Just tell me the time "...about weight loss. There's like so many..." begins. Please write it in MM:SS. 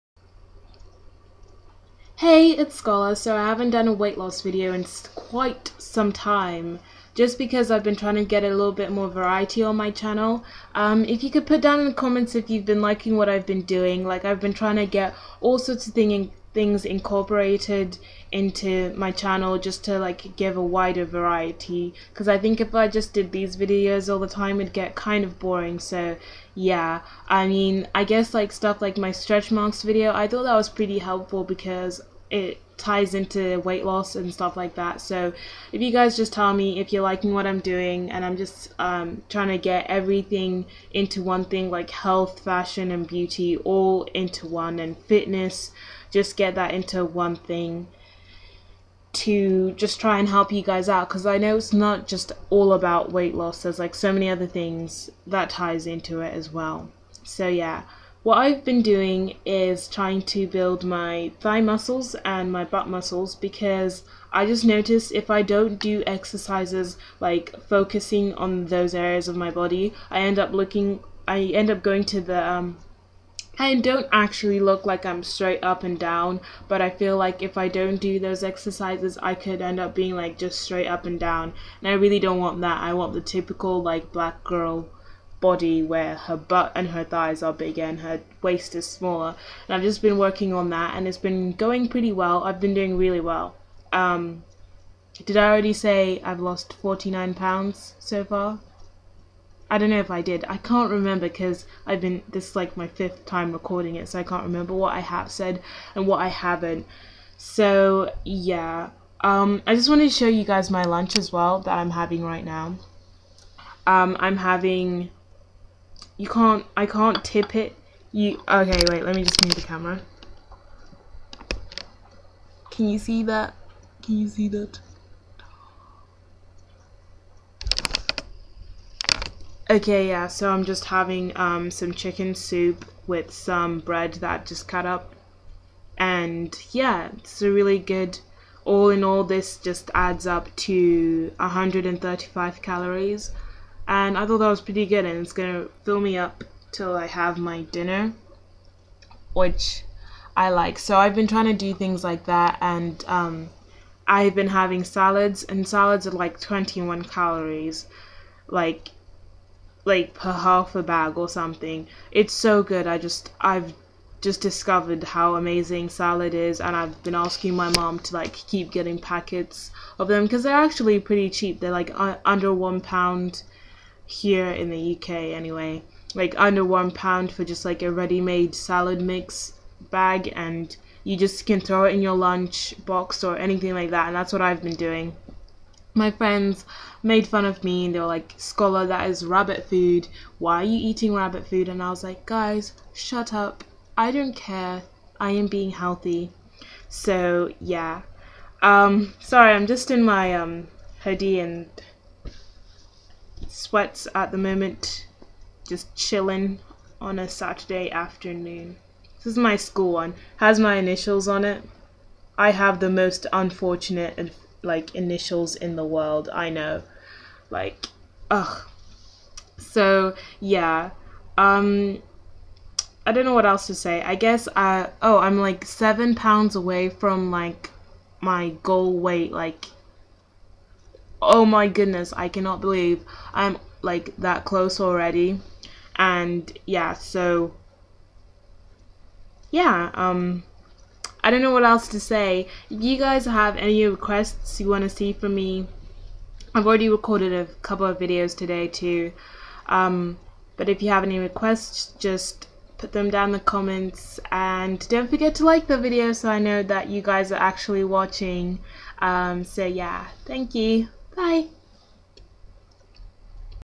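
00:52.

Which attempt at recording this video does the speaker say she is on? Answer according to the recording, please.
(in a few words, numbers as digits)
5th.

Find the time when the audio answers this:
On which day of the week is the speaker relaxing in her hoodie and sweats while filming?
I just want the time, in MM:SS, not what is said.
03:27.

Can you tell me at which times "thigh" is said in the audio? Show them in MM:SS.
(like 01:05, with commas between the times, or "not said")
01:01, 01:27.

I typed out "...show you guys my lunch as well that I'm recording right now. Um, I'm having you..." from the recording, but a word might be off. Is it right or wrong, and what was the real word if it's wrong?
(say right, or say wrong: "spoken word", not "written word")
wrong: "having", not "recording".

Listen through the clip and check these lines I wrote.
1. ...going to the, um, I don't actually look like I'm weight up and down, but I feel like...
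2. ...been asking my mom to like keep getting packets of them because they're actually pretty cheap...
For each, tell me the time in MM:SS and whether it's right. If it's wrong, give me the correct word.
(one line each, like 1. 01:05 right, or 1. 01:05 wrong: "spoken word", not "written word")
1. 01:11 wrong: "straight", not "weight"
2. 02:47 right.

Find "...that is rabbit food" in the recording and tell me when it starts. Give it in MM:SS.
03:08.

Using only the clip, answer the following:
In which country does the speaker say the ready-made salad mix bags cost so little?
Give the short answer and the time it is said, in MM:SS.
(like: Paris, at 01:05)
UK, at 02:54.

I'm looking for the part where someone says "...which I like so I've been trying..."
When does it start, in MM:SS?
02:29.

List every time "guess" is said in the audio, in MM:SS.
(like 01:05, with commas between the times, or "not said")
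00:28, 03:44.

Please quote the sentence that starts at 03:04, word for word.
And that's what I've been doing.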